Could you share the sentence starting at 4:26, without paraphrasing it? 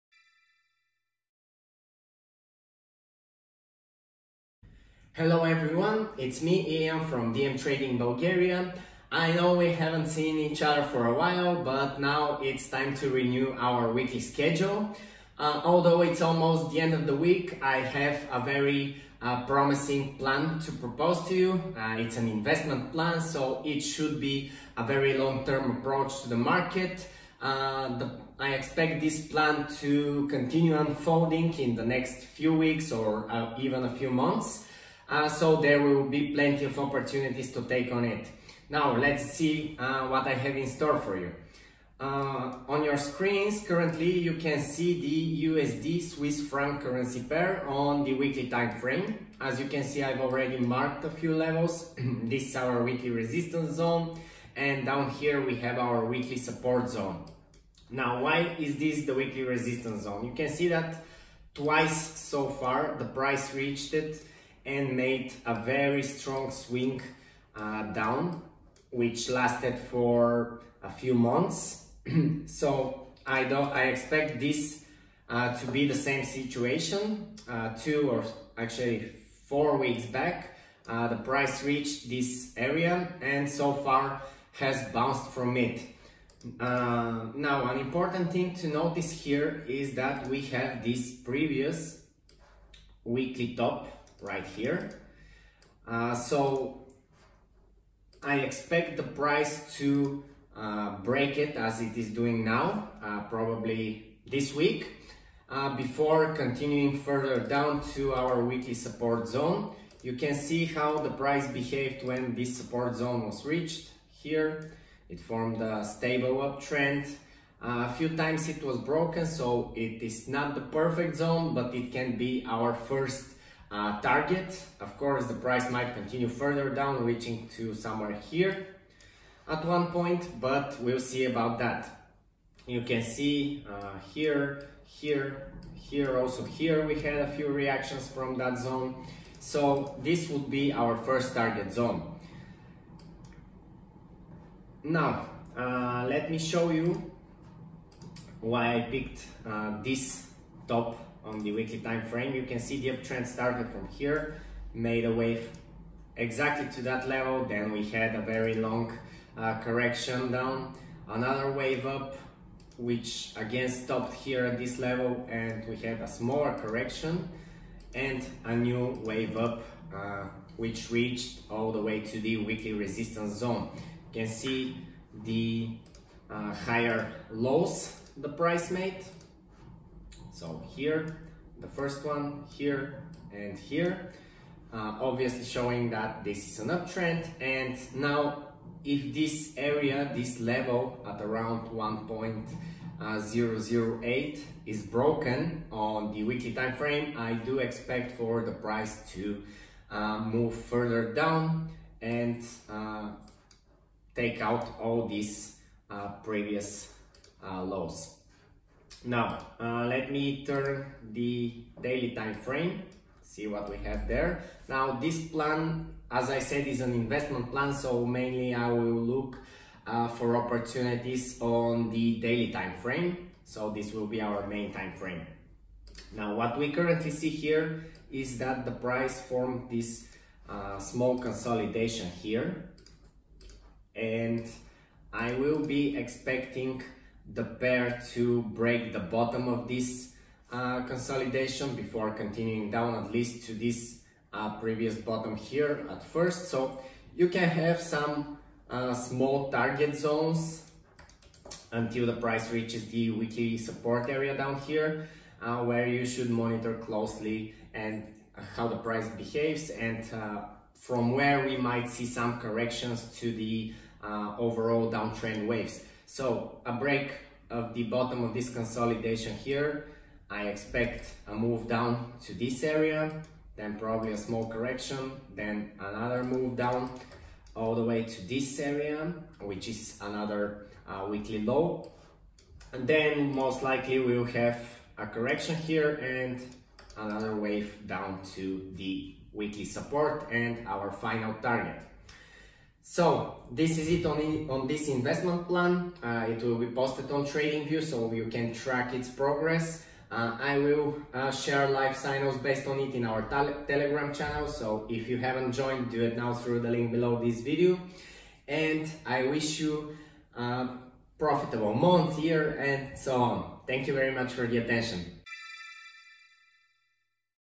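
So a break of the bottom of this consolidation here.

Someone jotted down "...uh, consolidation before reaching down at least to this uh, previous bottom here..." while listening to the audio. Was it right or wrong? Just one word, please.
wrong.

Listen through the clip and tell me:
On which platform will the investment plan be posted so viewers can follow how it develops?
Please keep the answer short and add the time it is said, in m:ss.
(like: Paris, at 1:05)
TradingView, at 4:57.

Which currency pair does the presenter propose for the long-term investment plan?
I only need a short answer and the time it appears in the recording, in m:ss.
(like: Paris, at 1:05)
USD Swiss franc, at 0:45.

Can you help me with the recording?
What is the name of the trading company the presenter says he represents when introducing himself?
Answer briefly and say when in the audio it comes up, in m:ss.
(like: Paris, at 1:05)
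DM Trading Bulgaria, at 0:07.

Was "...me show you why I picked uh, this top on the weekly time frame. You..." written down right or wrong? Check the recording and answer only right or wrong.
right.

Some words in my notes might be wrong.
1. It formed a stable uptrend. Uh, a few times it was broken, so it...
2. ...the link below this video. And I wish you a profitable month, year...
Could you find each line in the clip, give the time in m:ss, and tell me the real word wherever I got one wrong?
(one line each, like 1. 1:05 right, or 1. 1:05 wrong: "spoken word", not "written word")
1. 1:55 right
2. 5:06 right.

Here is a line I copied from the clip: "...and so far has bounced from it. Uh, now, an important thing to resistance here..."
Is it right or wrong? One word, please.
wrong.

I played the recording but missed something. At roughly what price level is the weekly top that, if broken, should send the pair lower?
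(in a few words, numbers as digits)
1.008.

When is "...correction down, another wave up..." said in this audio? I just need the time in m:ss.
2:39.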